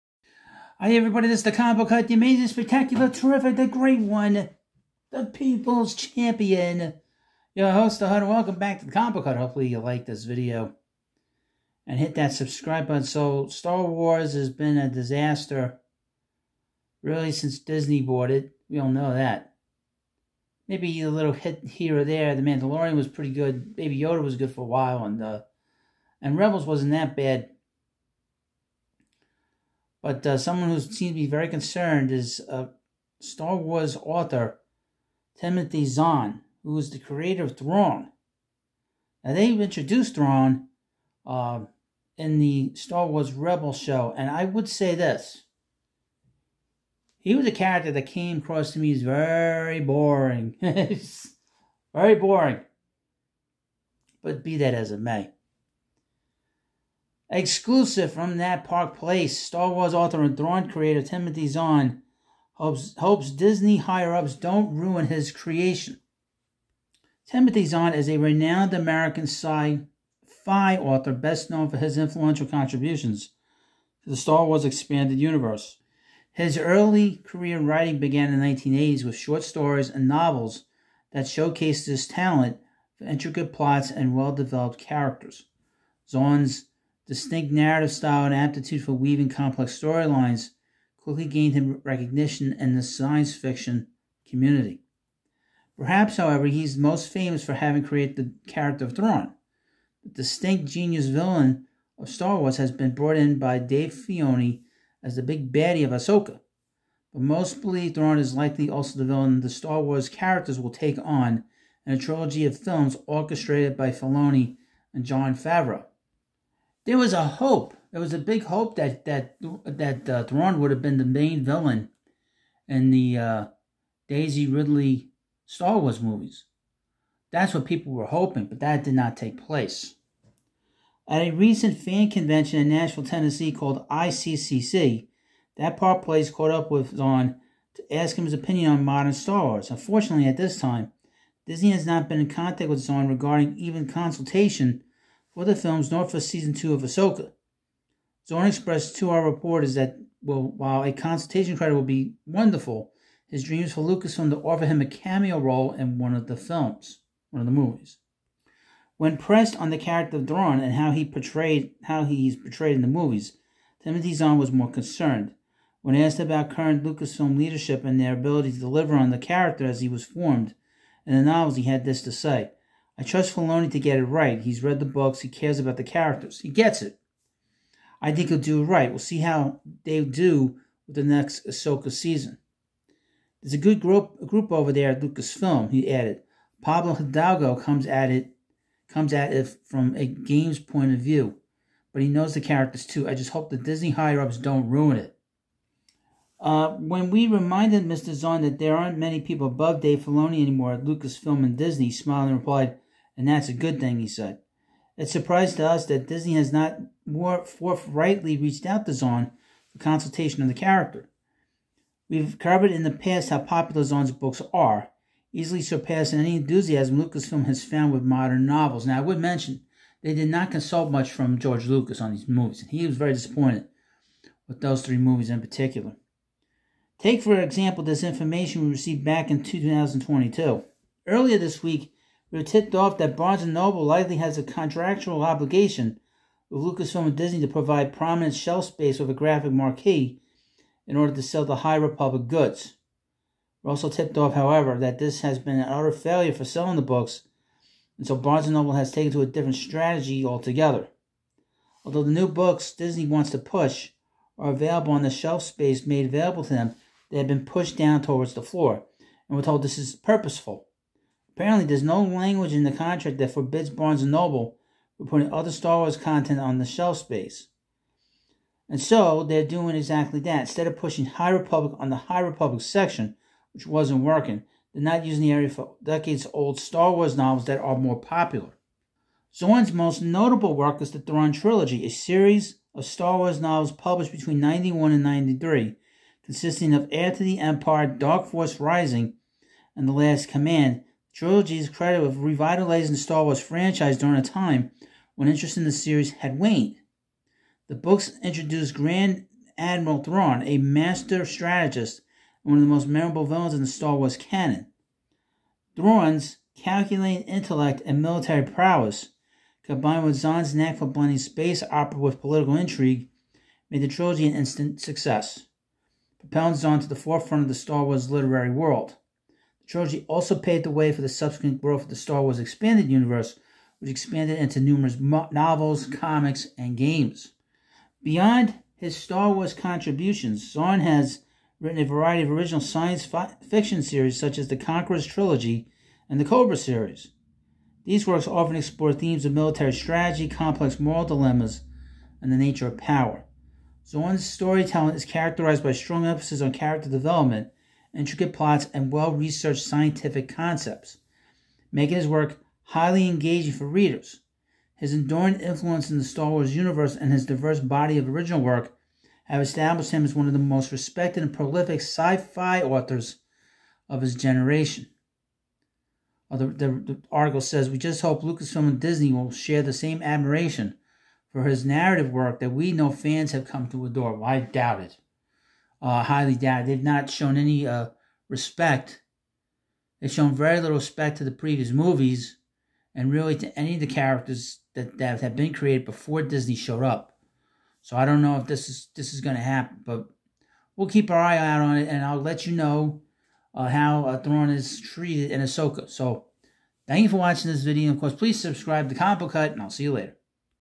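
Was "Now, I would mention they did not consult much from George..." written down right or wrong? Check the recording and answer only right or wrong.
right.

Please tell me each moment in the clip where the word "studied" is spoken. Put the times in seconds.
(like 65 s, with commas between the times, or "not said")
not said.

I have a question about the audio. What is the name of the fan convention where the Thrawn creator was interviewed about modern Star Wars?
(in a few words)
ICCC.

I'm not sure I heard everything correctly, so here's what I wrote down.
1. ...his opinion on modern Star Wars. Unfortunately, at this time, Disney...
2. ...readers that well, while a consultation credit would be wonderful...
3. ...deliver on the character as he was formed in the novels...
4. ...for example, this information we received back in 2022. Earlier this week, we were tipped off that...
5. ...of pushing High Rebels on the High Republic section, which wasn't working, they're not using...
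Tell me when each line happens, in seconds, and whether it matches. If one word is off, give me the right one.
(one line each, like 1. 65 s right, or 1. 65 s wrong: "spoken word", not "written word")
1. 138 s right
2. 149 s wrong: "reporters", not "readers"
3. 168 s right
4. 227 s right
5. 270 s wrong: "Republic", not "Rebels".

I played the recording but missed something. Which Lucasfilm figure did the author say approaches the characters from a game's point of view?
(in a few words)
Pablo Hidalgo.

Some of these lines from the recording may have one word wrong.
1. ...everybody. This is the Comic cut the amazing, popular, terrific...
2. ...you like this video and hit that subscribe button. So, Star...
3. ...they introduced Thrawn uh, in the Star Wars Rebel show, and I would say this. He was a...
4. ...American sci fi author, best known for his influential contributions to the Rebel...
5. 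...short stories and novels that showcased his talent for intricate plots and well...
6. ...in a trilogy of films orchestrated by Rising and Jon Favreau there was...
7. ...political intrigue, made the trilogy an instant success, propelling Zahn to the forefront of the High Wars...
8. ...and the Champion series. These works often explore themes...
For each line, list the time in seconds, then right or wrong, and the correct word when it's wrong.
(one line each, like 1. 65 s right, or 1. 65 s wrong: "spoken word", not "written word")
1. 0 s wrong: "spectacular", not "popular"
2. 9 s right
3. 39 s right
4. 68 s wrong: "Star", not "Rebel"
5. 79 s right
6. 111 s wrong: "Filoni", not "Rising"
7. 312 s wrong: "Star", not "High"
8. 336 s wrong: "Cobra", not "Champion".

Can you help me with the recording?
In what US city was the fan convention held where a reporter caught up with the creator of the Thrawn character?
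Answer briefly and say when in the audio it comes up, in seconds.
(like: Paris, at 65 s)
Nashville, at 132 s.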